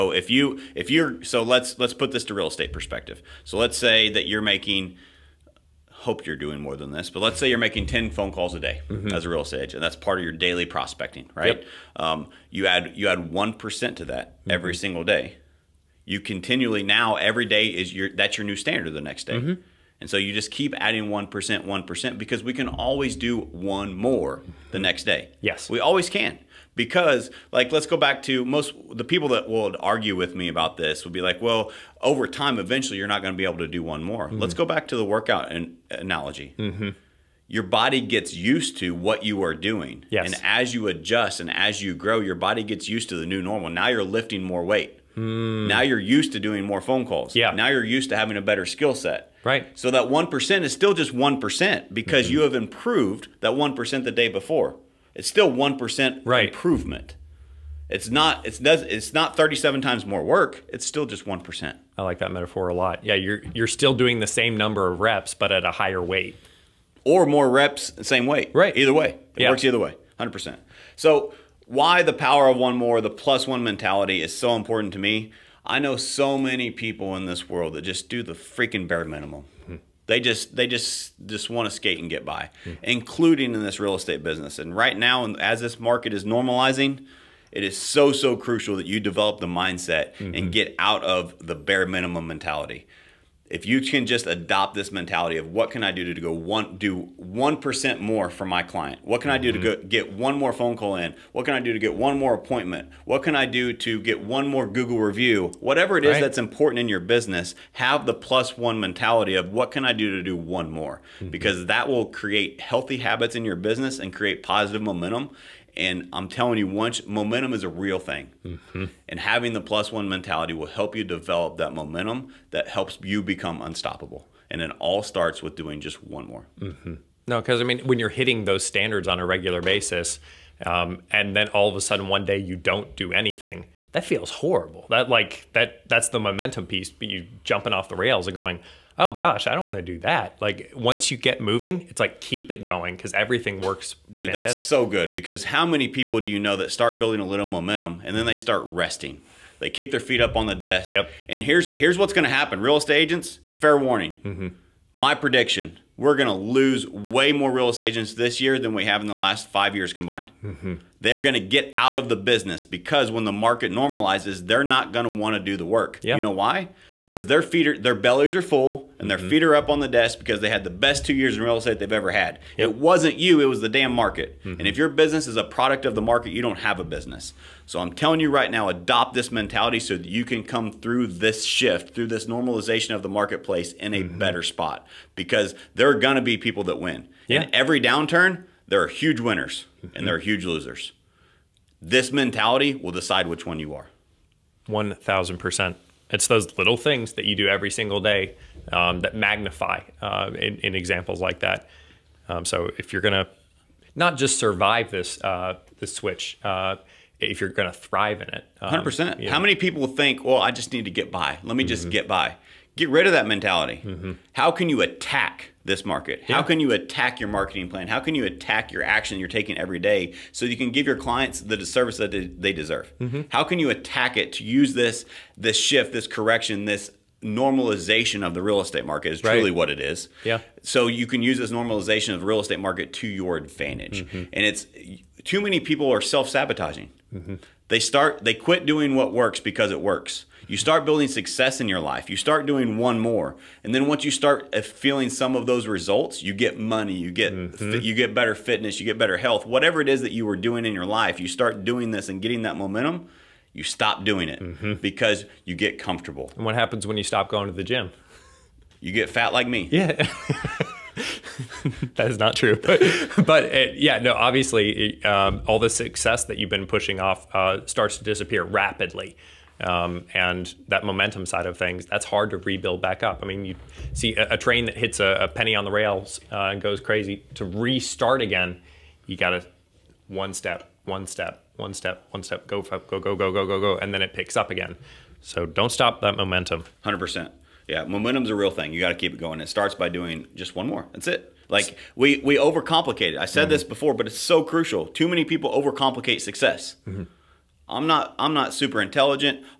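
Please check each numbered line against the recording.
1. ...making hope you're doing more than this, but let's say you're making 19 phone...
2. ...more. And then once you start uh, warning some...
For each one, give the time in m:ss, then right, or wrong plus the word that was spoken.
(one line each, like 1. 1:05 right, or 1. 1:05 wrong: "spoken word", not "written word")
1. 0:04 wrong: "10", not "19"
2. 4:02 wrong: "feeling", not "warning".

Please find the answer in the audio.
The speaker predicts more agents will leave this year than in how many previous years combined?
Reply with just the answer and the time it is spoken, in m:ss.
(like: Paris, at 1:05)
5, at 2:39.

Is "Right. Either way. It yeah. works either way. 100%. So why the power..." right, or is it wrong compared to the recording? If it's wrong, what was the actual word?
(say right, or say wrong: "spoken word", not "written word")
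right.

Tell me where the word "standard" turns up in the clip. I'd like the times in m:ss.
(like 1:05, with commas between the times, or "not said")
0:18, 2:08.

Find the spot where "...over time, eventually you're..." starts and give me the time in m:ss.
0:32.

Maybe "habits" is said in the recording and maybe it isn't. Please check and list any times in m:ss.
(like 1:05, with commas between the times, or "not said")
1:52.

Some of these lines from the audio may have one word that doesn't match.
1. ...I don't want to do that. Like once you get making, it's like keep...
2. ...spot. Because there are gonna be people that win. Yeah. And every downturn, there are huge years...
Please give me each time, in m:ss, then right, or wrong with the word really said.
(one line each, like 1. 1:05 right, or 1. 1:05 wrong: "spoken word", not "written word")
1. 2:19 wrong: "moving", not "making"
2. 3:04 wrong: "winners", not "years".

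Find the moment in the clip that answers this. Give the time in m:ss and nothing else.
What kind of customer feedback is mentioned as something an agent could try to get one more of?
1:44.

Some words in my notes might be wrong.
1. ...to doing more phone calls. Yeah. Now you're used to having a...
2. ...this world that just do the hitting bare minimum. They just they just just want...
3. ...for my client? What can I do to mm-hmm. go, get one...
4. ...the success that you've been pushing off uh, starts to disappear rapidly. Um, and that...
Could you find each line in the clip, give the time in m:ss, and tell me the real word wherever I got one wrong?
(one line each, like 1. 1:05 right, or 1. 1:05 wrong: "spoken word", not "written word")
1. 0:46 right
2. 1:17 wrong: "freaking", not "hitting"
3. 1:38 right
4. 4:25 right.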